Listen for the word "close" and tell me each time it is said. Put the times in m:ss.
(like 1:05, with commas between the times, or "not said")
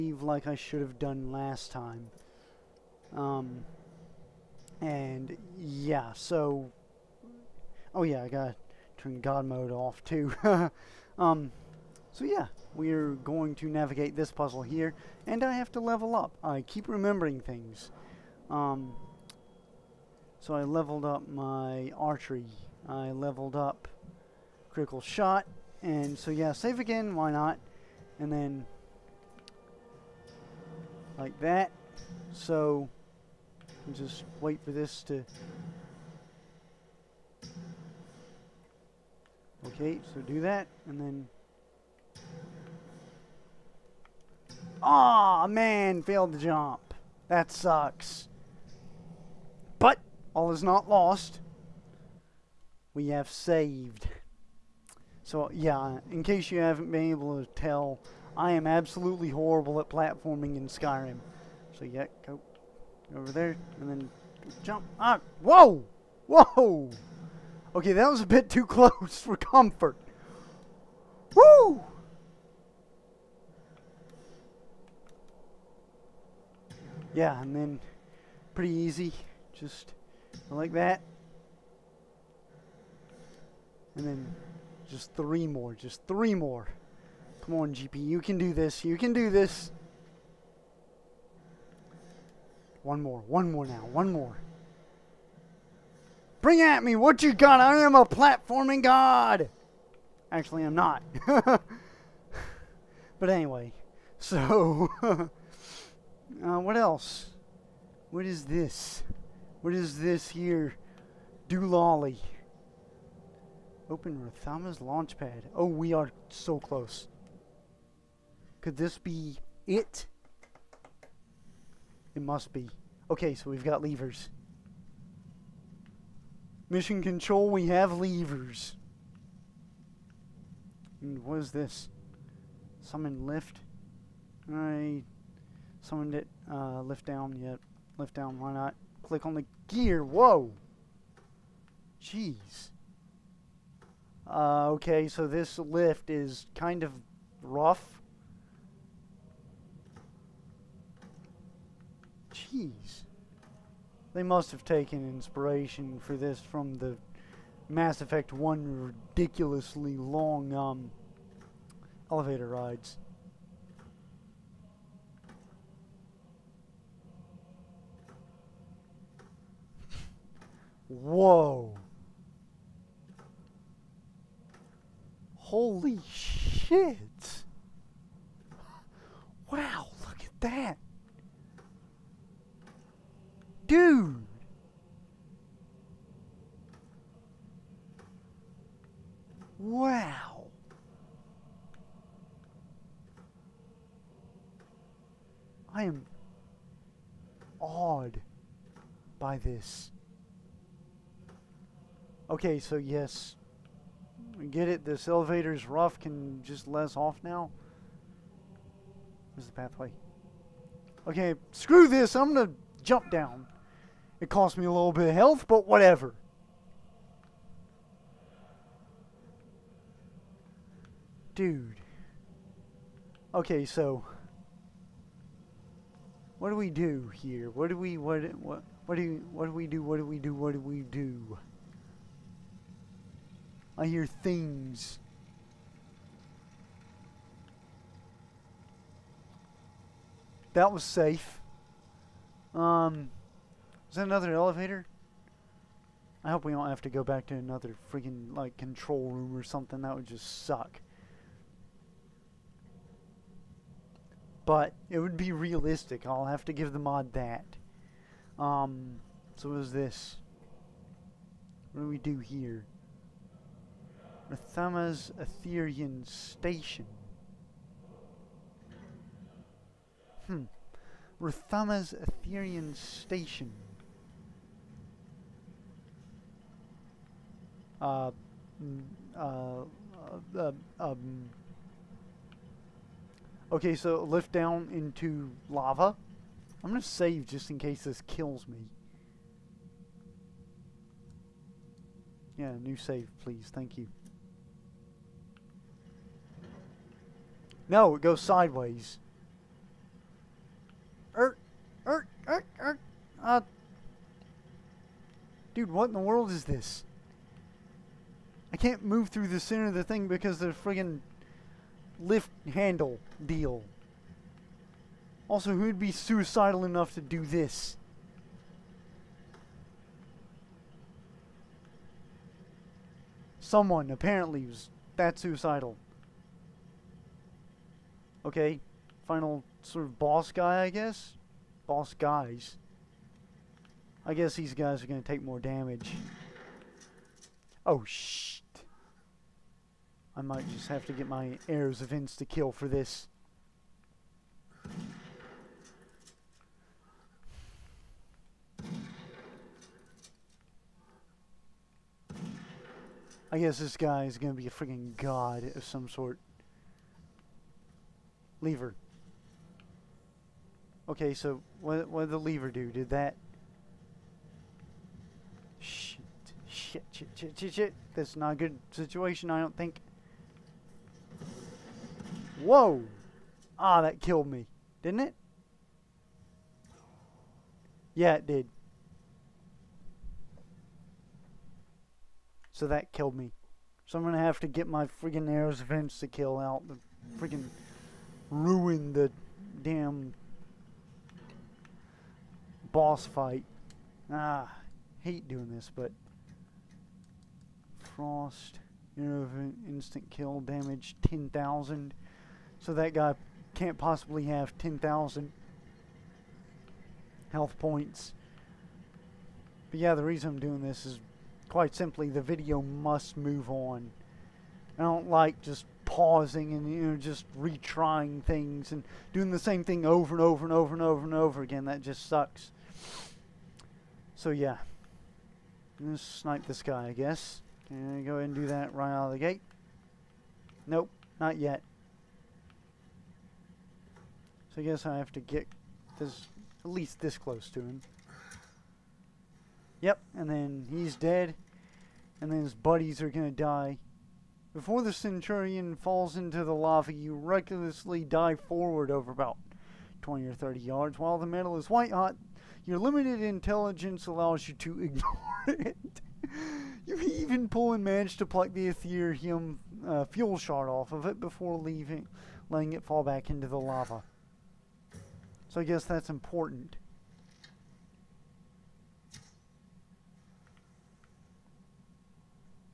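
1:08, 1:56, 7:17.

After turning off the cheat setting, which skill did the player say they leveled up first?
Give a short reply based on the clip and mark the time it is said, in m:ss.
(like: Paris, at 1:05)
Archery, at 0:21.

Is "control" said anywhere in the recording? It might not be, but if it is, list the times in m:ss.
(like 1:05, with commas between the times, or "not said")
2:07, 4:08.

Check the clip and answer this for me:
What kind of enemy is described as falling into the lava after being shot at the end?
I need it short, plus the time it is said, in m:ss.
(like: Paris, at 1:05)
Centurion, at 7:24.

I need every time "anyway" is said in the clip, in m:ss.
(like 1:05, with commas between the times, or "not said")
1:43.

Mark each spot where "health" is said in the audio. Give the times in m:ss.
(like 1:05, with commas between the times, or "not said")
3:35, 6:47.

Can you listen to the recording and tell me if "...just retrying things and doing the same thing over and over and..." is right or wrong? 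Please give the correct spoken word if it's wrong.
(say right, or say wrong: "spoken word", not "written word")
right.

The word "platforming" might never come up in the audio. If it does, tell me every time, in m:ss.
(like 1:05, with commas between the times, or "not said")
0:59, 1:38.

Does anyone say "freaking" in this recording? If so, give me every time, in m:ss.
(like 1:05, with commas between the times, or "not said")
4:07, 5:54.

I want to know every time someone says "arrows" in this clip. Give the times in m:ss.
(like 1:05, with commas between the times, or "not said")
5:41, 6:25.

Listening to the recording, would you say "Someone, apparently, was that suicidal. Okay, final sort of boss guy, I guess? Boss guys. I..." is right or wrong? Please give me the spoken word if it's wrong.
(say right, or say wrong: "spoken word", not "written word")
right.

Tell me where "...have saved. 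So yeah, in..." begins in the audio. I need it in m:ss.
0:53.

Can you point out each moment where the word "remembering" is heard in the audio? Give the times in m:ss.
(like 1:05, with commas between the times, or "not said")
0:16.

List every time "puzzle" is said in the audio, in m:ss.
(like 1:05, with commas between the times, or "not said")
0:14.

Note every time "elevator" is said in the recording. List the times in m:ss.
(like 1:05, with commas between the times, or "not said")
2:42, 3:25, 4:04.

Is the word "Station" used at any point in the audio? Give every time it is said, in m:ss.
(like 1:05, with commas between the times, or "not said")
4:26, 4:32.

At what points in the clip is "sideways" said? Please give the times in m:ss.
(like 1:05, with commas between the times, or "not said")
4:58.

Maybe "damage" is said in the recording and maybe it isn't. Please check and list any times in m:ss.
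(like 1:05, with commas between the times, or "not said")
5:35, 6:40.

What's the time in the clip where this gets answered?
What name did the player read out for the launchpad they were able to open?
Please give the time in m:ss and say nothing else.
1:54.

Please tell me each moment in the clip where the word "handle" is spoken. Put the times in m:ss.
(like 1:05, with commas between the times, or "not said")
5:12.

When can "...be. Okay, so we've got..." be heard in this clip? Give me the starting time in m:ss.
2:02.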